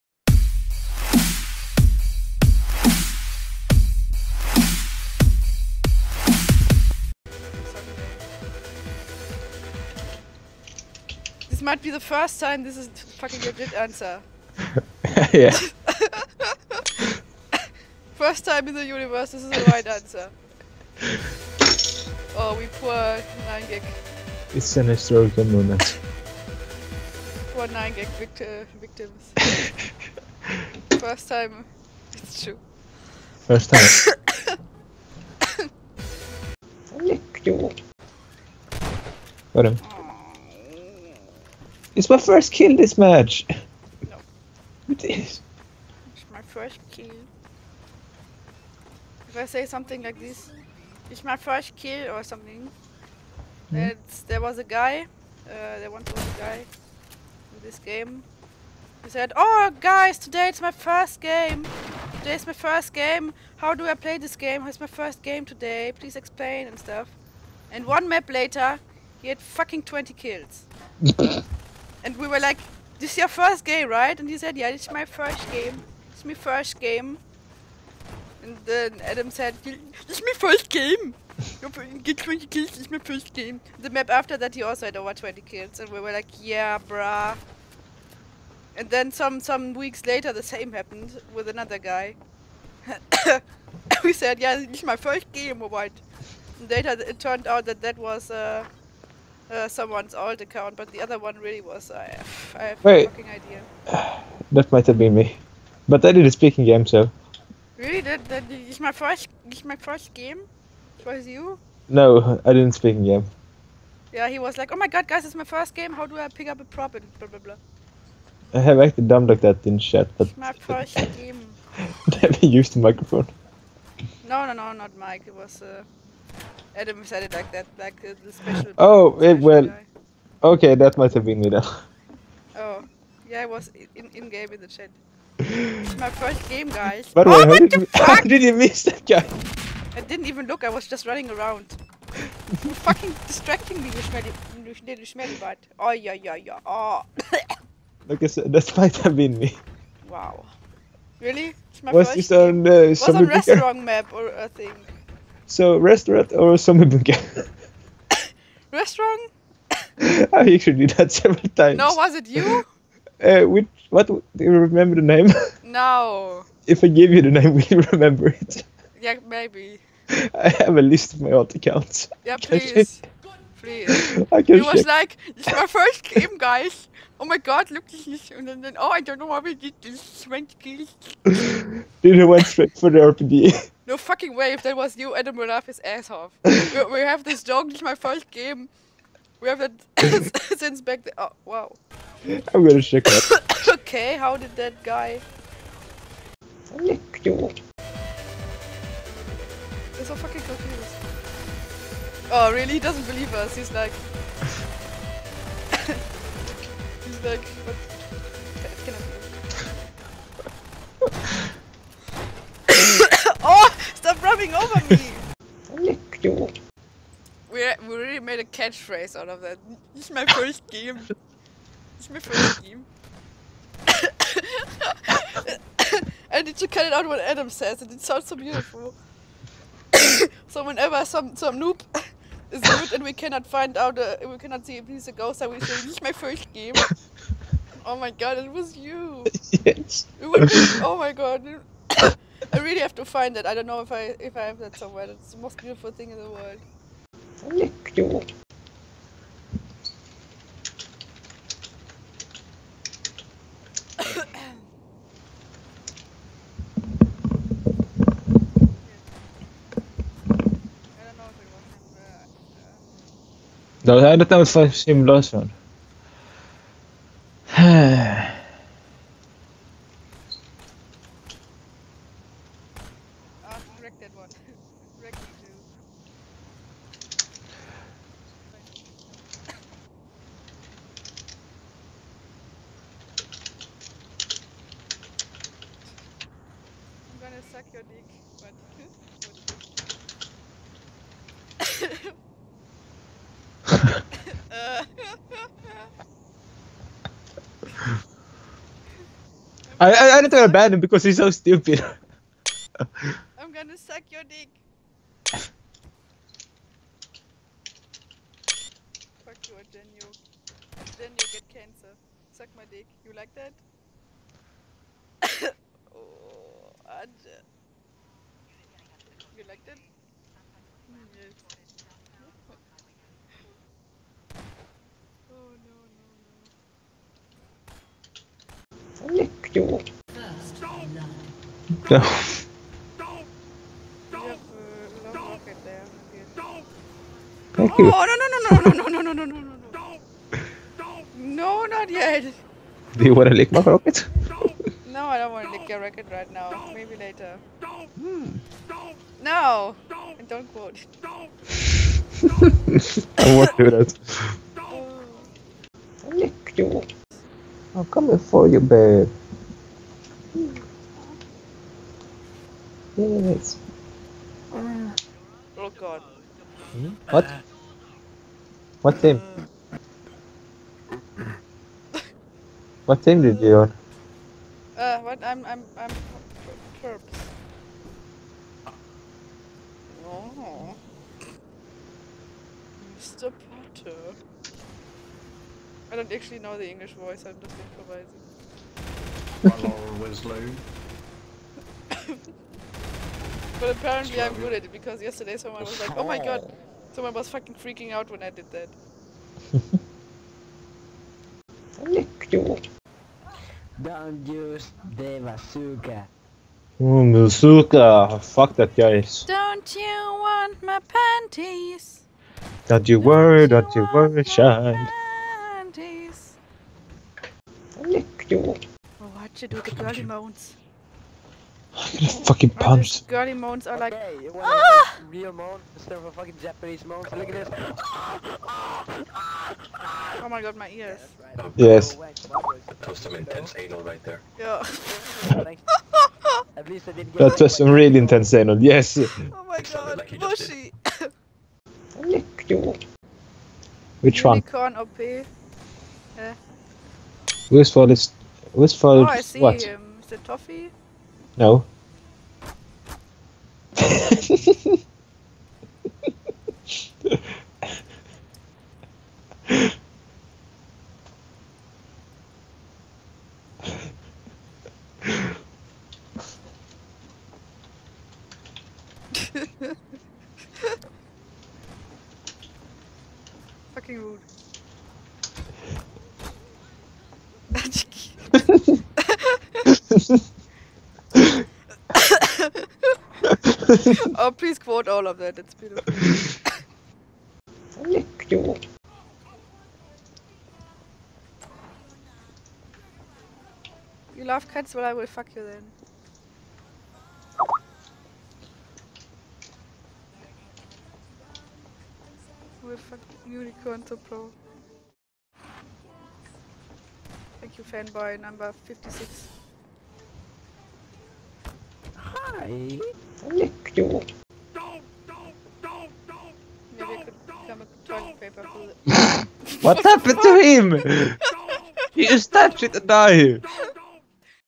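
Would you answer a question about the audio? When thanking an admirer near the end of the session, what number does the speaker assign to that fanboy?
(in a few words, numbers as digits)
56.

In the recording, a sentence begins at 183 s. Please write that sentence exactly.
No fucking way, if that was you, Adam will laugh his ass off.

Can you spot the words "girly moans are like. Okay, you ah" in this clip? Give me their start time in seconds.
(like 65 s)
423 s.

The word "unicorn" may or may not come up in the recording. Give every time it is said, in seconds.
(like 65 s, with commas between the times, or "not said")
444 s, 503 s.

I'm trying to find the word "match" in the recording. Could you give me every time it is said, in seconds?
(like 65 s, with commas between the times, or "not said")
42 s.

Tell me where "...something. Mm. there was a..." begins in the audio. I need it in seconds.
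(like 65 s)
52 s.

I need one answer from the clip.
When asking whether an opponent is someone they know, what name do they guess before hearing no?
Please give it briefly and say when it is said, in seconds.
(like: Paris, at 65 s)
Toffee, at 450 s.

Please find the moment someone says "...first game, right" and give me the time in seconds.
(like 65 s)
73 s.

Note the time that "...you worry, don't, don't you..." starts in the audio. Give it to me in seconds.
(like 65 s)
412 s.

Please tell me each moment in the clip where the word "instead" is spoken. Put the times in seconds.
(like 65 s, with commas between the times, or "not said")
425 s.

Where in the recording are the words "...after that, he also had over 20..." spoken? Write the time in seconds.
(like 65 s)
84 s.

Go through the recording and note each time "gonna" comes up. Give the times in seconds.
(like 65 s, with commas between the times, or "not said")
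192 s, 303 s.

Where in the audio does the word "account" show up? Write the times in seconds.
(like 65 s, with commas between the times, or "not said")
100 s, 171 s.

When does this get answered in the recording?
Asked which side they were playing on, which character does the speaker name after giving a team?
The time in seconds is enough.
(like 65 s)
382 s.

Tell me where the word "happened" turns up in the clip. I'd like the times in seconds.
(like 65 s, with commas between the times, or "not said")
90 s, 519 s.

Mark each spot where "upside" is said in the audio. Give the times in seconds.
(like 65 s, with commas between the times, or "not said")
not said.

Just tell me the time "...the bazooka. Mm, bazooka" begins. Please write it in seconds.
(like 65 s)
404 s.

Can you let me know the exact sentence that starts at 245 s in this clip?
It's the most beautiful thing in the world.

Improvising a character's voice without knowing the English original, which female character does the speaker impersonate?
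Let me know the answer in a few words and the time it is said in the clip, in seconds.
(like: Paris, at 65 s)
Laura Winslow, at 389 s.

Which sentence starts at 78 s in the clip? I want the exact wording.
And then Adam said, is my first game.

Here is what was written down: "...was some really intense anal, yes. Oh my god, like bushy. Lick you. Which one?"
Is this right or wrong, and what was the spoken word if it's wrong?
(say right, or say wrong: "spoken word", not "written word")
right.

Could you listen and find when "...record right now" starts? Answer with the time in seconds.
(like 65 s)
345 s.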